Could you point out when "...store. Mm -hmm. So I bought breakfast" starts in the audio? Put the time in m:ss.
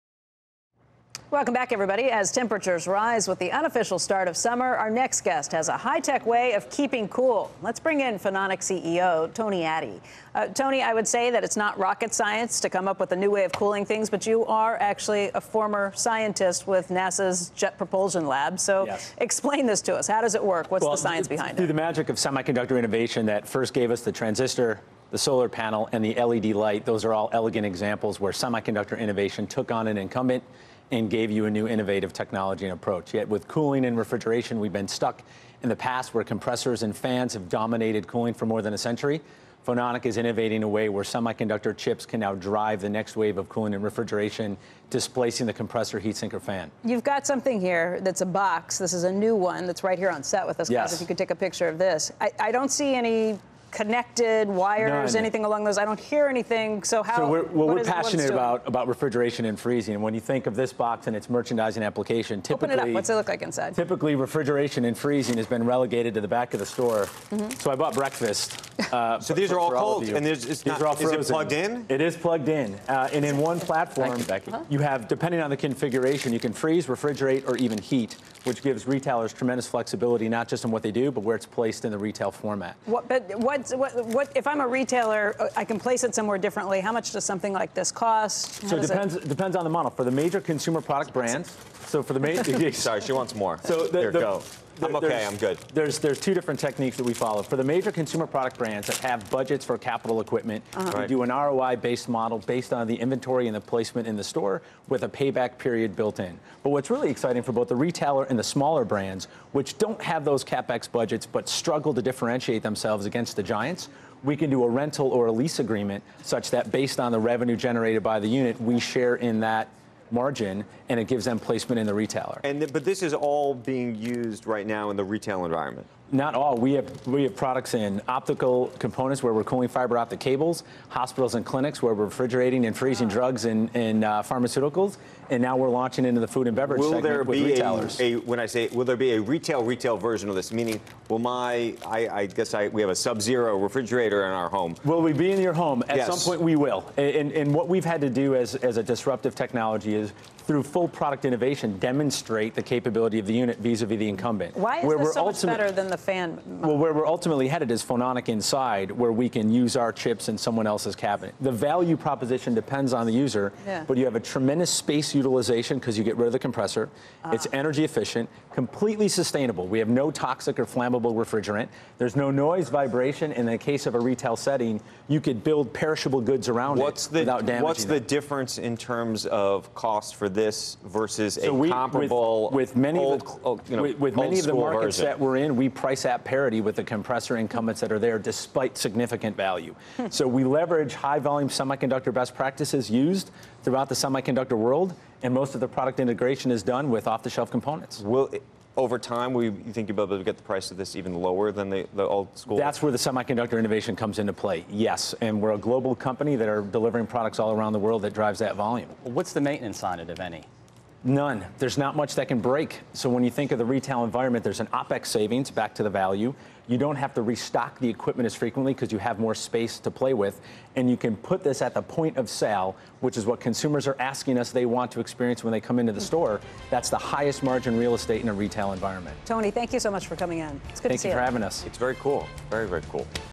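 1:06.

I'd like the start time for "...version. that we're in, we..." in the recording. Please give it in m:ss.
3:04.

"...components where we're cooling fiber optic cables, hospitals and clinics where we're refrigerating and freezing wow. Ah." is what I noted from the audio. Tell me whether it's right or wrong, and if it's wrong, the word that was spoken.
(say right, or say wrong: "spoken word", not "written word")
right.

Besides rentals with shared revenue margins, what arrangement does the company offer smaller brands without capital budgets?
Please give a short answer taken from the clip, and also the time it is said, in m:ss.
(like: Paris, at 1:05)
lease agreement, at 1:55.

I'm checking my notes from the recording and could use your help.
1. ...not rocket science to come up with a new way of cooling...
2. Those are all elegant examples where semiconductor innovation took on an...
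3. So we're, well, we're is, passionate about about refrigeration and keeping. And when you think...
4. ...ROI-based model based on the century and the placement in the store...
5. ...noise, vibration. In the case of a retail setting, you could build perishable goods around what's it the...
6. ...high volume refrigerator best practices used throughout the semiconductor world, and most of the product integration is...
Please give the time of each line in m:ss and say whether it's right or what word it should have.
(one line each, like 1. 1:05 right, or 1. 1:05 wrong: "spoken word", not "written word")
1. 0:11 right
2. 0:26 right
3. 0:57 wrong: "freezing", not "keeping"
4. 1:41 wrong: "inventory", not "century"
5. 2:52 right
6. 3:10 wrong: "semiconductor", not "refrigerator".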